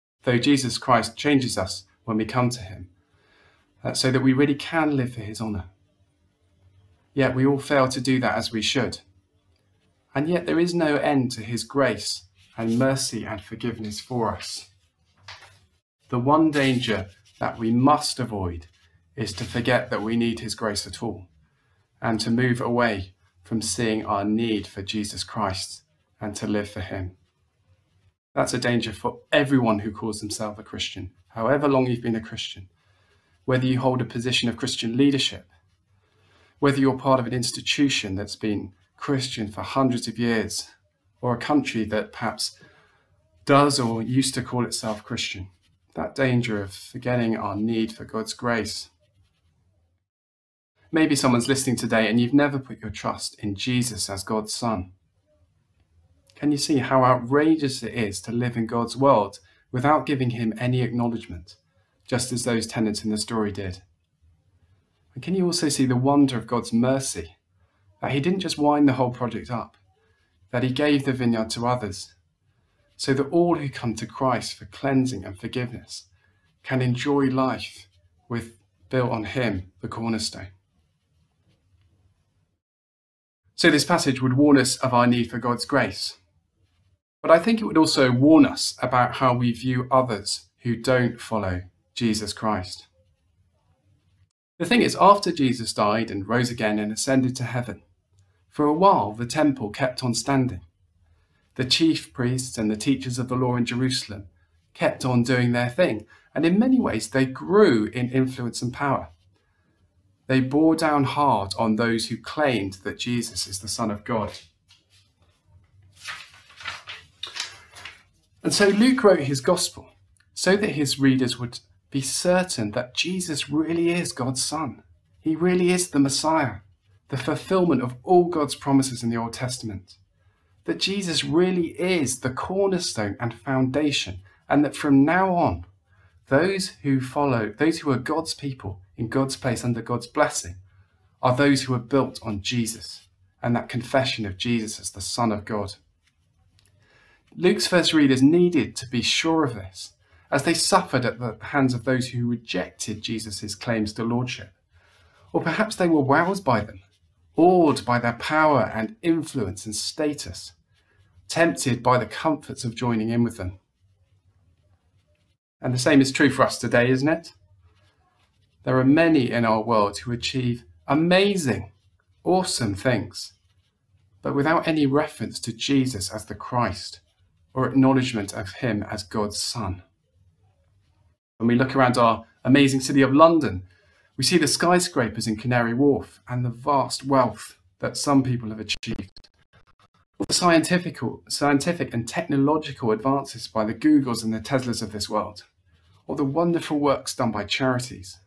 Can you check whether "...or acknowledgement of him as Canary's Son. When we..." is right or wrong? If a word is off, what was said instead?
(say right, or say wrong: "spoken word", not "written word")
wrong: "God", not "Canary".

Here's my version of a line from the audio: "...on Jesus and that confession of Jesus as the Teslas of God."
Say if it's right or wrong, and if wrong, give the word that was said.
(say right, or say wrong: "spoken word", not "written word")
wrong: "Son", not "Teslas".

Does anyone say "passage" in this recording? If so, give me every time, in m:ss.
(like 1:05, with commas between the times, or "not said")
1:23.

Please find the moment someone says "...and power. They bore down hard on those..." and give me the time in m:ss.
1:48.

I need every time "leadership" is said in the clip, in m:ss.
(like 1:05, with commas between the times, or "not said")
0:34.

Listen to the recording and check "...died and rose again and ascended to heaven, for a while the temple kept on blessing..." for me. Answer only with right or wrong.
wrong.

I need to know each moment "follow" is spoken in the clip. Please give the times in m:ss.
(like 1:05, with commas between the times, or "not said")
1:31, 2:16.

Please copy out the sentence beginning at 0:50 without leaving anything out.
Maybe someone's listening today and you've never put your trust in Jesus as God's Son.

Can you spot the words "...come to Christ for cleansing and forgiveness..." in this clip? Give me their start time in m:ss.
1:13.